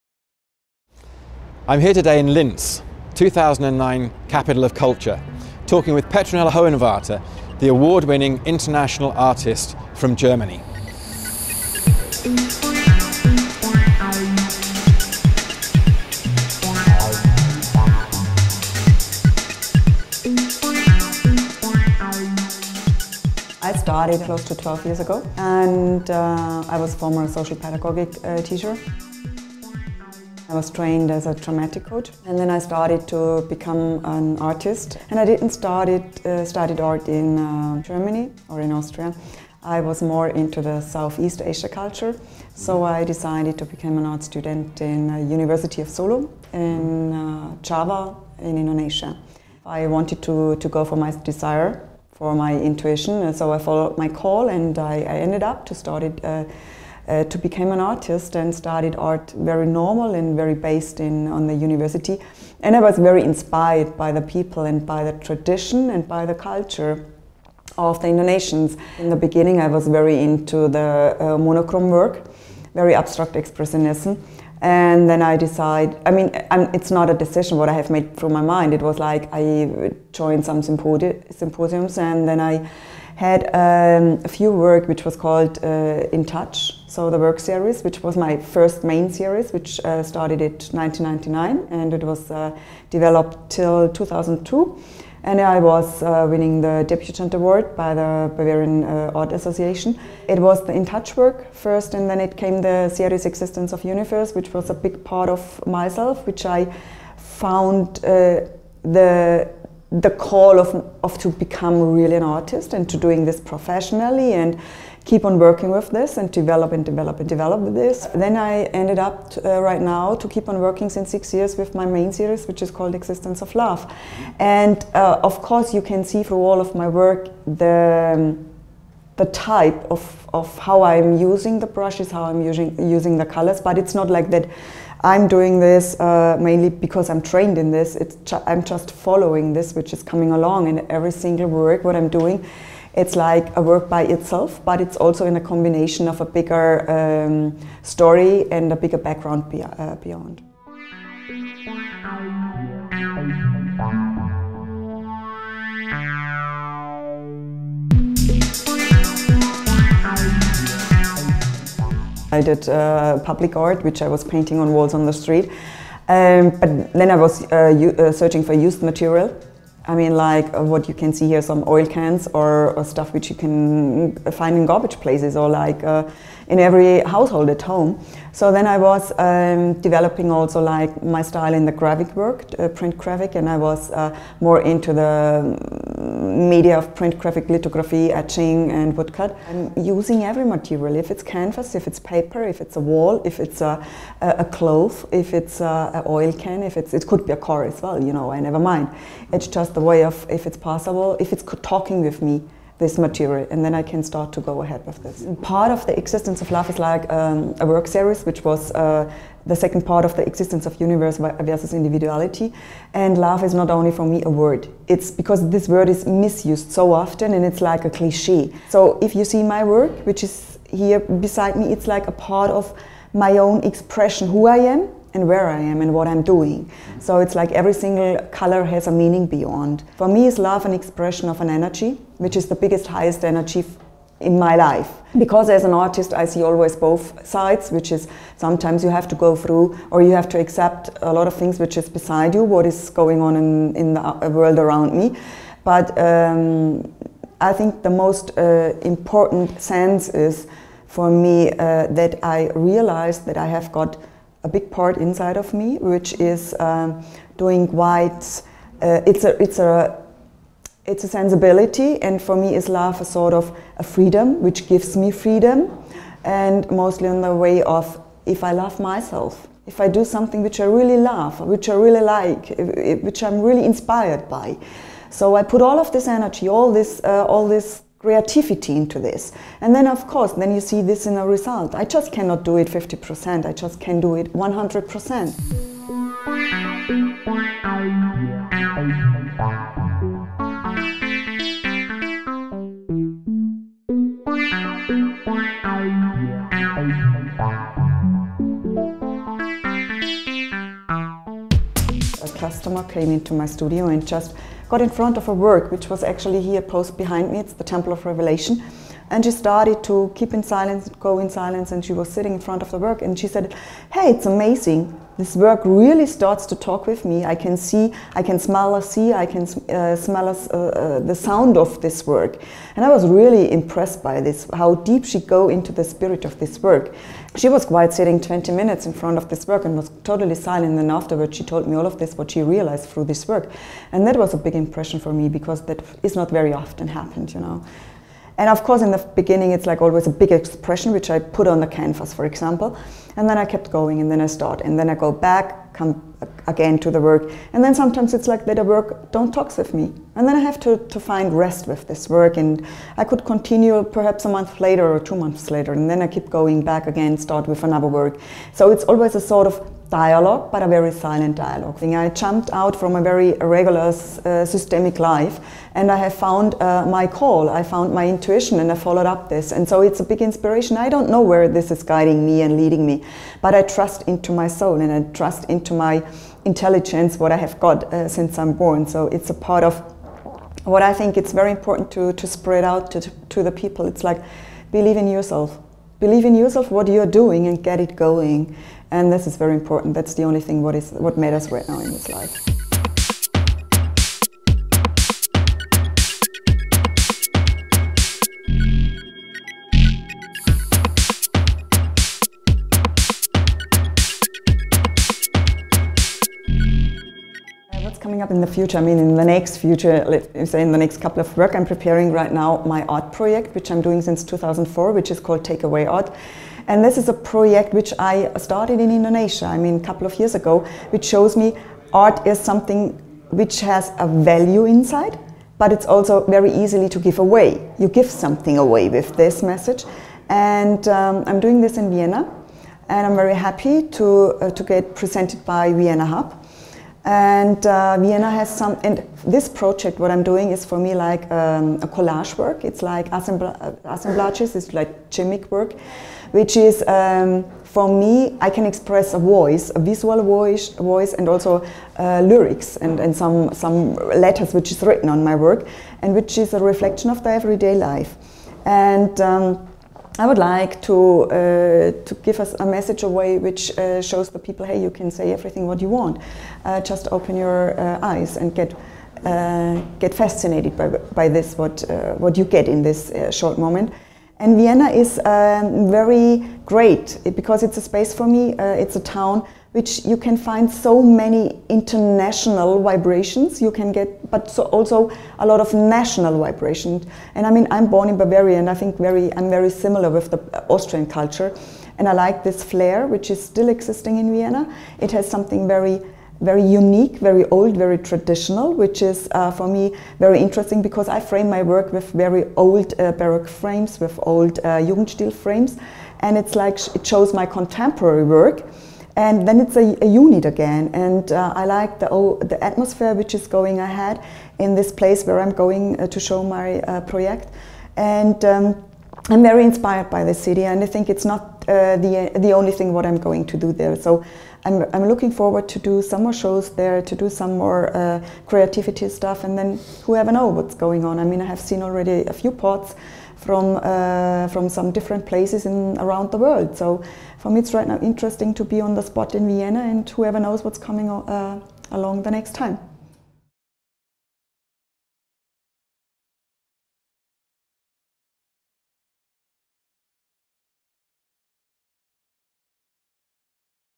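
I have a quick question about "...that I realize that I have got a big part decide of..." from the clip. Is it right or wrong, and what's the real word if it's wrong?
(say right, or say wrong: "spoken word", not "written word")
wrong: "inside", not "decide".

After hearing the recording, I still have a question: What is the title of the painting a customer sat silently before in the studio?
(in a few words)
Temple of Revelation.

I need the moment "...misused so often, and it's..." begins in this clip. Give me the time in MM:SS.
03:36.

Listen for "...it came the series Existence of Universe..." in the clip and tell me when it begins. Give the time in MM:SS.
01:42.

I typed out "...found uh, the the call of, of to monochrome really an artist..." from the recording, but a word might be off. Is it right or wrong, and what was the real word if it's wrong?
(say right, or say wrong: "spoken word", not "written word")
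wrong: "become", not "monochrome".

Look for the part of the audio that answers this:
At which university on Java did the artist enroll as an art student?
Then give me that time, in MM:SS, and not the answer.
00:45.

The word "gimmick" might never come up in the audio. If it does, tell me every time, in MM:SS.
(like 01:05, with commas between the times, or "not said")
07:25.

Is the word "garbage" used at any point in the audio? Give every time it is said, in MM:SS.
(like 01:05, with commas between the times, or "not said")
02:54.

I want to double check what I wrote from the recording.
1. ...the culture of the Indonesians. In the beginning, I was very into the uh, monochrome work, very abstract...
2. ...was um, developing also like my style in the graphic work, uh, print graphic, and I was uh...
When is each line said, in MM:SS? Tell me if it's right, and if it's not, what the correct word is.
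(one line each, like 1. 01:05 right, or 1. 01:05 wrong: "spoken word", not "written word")
1. 01:06 right
2. 02:58 right.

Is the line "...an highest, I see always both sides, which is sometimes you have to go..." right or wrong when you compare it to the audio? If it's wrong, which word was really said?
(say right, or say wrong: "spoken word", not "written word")
wrong: "artist", not "highest".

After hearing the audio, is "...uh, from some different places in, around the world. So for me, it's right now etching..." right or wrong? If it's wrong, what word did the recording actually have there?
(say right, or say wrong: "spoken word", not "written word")
wrong: "interesting", not "etching".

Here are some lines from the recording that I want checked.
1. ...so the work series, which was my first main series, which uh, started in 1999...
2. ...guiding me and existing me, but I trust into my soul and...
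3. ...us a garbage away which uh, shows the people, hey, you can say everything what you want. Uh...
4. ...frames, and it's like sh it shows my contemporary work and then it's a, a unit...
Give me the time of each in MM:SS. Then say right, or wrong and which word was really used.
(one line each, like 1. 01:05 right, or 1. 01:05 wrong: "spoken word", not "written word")
1. 01:26 right
2. 06:11 wrong: "leading", not "existing"
3. 07:42 wrong: "message", not "garbage"
4. 08:25 right.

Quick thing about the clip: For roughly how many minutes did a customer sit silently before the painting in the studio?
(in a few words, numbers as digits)
20.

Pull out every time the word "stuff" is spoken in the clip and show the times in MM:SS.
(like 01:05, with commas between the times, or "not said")
02:52, 08:49.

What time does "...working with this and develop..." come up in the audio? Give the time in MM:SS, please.
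01:55.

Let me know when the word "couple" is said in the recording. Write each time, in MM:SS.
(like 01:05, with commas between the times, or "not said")
06:51, 06:59.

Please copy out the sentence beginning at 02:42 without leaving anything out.
I did uh, public art, which I was painting on walls on the street.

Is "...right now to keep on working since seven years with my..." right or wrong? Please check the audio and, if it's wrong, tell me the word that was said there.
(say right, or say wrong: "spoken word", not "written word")
wrong: "six", not "seven".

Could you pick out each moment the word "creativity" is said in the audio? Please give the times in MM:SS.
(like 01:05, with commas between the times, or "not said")
04:38, 08:48.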